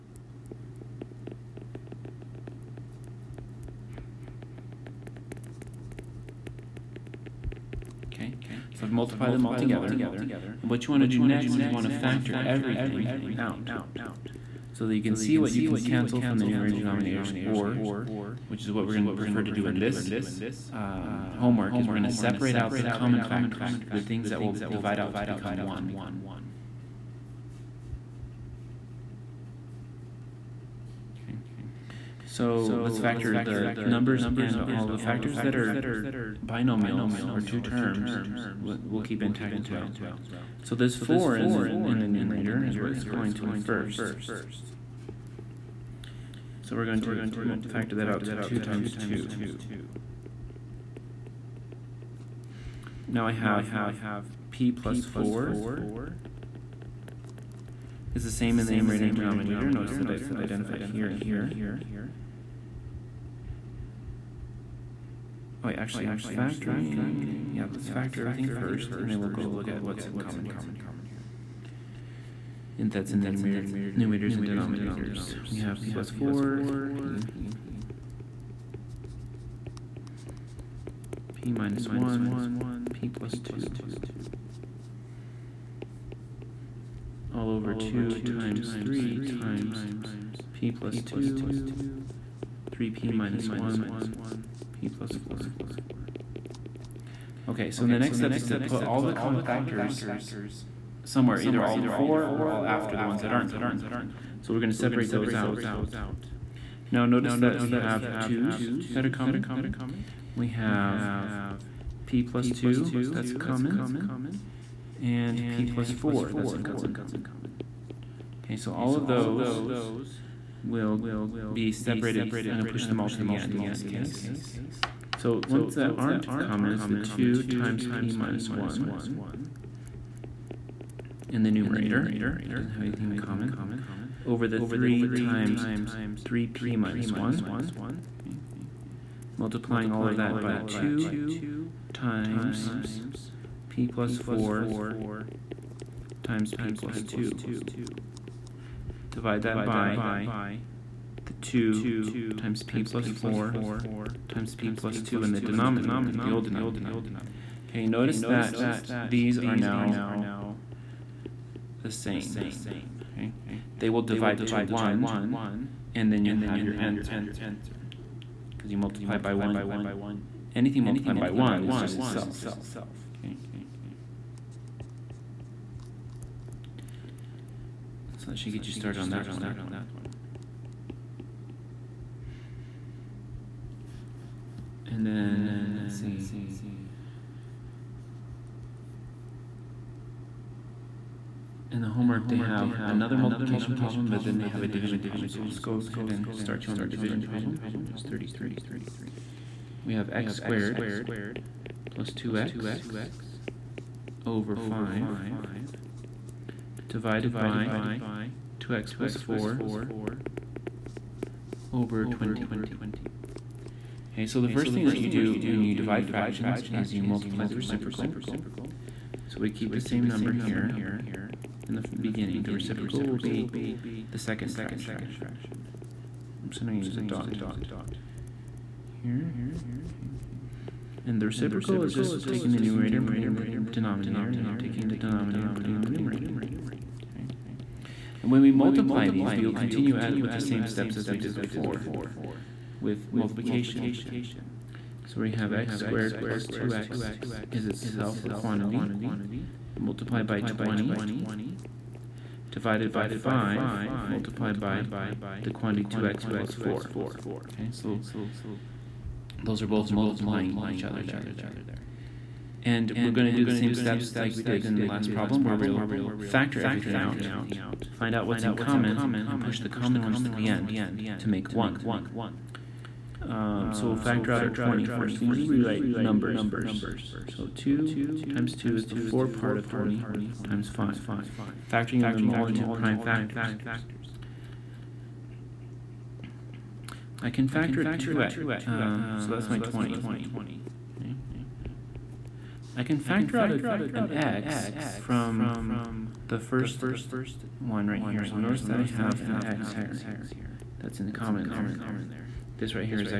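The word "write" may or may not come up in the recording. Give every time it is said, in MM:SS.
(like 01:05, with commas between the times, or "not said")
04:35.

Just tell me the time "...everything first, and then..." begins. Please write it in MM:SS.
01:08.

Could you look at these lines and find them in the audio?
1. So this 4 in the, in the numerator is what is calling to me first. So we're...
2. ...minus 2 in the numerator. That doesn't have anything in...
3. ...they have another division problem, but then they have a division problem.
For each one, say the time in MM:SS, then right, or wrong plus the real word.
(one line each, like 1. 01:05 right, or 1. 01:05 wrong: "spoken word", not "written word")
1. 00:40 right
2. 02:08 wrong: "1", not "2"
3. 03:12 wrong: "multiplication", not "division".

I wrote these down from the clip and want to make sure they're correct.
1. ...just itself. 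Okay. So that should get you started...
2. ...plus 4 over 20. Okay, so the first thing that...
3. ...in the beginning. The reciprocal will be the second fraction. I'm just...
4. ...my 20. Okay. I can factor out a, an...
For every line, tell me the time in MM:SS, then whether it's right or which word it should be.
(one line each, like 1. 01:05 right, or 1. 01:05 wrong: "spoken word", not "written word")
1. 02:51 right
2. 03:28 right
3. 03:41 right
4. 04:49 right.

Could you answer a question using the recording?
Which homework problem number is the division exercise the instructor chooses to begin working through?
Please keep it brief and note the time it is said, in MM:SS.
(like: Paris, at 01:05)
33, at 03:18.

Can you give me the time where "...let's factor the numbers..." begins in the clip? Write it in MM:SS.
00:32.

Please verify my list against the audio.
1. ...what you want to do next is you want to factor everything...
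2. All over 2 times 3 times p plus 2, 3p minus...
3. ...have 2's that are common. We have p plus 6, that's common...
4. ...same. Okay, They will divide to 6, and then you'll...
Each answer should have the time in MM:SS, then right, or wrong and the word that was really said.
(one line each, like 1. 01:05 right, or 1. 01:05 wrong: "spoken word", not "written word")
1. 00:10 right
2. 01:27 right
3. 01:47 wrong: "2", not "6"
4. 02:41 wrong: "1", not "6".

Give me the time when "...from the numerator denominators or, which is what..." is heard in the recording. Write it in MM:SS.
00:16.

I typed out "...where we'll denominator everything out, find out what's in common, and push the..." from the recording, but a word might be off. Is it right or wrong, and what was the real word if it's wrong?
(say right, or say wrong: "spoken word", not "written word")
wrong: "factor", not "denominator".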